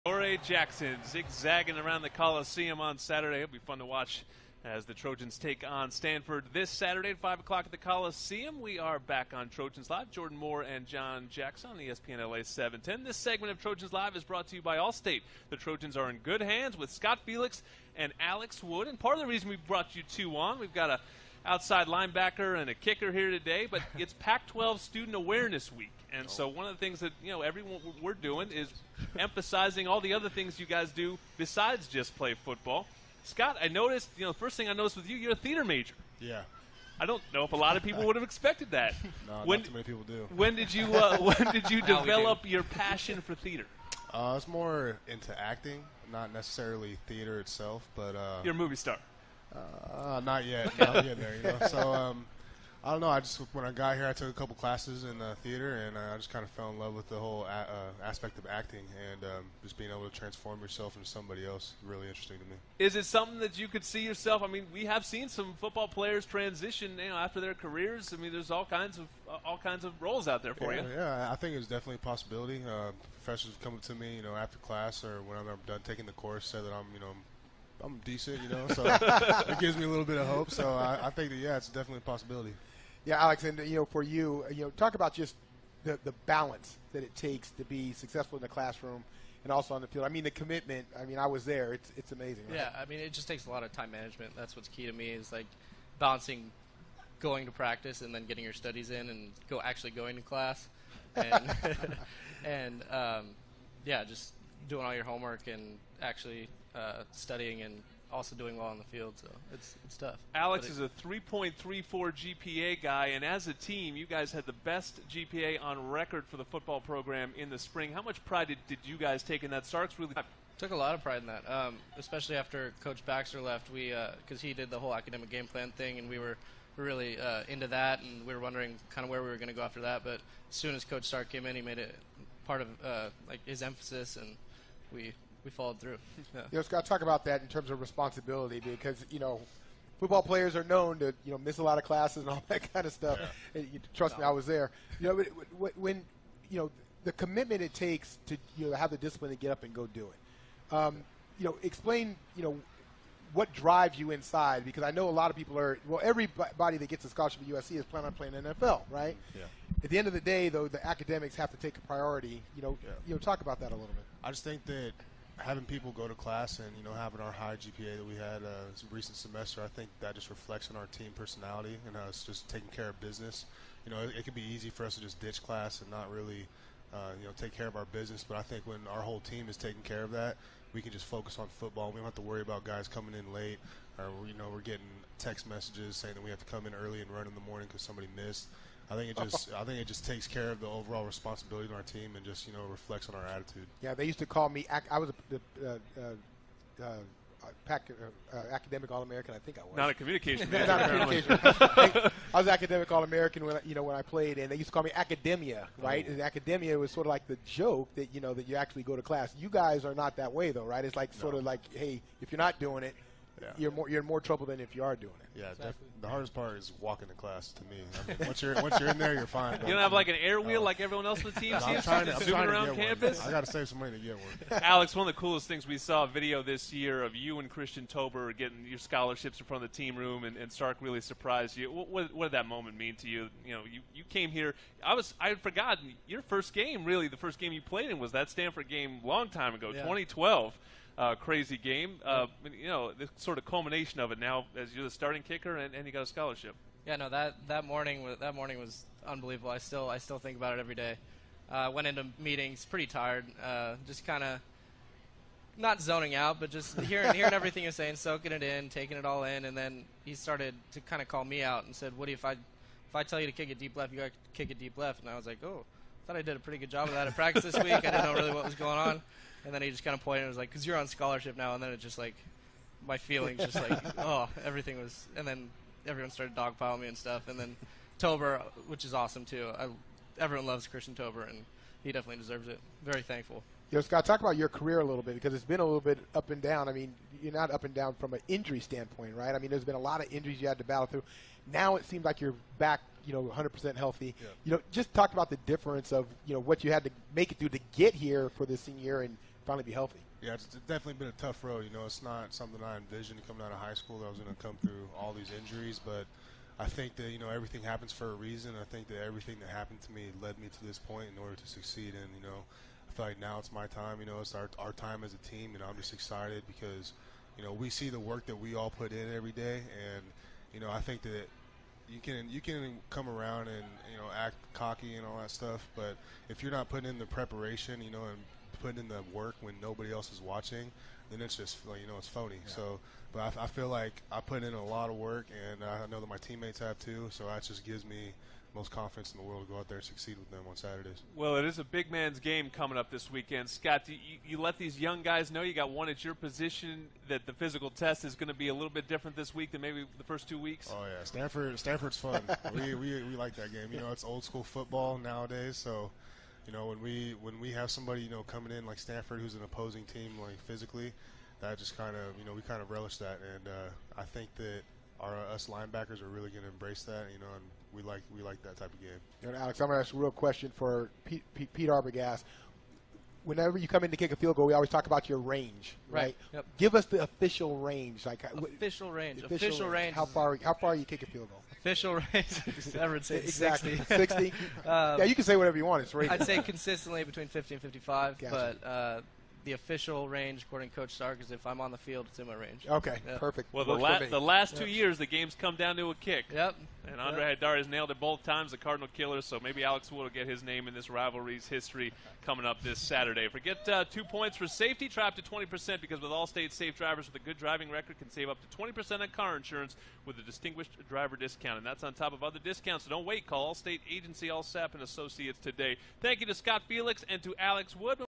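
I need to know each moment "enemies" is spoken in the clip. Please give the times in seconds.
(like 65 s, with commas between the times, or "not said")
not said.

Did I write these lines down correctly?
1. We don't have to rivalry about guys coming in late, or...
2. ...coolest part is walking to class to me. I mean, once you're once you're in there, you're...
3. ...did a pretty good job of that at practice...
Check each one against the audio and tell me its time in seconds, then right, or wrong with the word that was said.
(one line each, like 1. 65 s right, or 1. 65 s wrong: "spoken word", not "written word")
1. 181 s wrong: "worry", not "rivalry"
2. 216 s wrong: "hardest", not "coolest"
3. 266 s right.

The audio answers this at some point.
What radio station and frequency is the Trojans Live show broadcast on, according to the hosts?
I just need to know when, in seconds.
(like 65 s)
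11 s.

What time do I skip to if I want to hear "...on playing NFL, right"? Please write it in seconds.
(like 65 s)
158 s.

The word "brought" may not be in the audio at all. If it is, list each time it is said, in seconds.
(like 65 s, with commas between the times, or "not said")
14 s, 19 s.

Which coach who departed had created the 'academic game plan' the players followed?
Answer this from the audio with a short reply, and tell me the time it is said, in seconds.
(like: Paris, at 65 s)
Coach Baxter, at 122 s.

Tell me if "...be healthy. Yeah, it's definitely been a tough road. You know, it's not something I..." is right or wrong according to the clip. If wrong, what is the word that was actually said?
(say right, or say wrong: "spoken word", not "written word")
right.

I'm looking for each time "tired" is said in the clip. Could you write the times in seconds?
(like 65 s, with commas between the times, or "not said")
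252 s.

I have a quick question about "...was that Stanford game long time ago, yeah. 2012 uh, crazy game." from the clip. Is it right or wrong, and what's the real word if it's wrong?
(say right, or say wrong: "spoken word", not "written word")
right.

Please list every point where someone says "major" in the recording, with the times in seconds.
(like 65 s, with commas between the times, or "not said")
35 s, 200 s.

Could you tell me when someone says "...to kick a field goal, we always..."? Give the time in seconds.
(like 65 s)
373 s.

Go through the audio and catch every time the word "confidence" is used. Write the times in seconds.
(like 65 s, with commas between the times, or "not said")
338 s.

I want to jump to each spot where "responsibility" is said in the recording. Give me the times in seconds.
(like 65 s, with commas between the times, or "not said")
137 s, 191 s.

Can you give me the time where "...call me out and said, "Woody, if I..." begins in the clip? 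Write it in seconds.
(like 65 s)
261 s.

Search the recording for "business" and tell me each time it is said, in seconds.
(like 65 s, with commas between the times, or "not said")
172 s, 177 s.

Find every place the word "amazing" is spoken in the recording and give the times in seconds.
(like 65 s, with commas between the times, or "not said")
92 s.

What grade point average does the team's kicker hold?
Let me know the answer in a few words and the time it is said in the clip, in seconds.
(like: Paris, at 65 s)
3.34, at 111 s.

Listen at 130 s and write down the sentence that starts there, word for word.
But as soon as Coach Stark came in, he made it part of uh, like his emphasis and we we followed through.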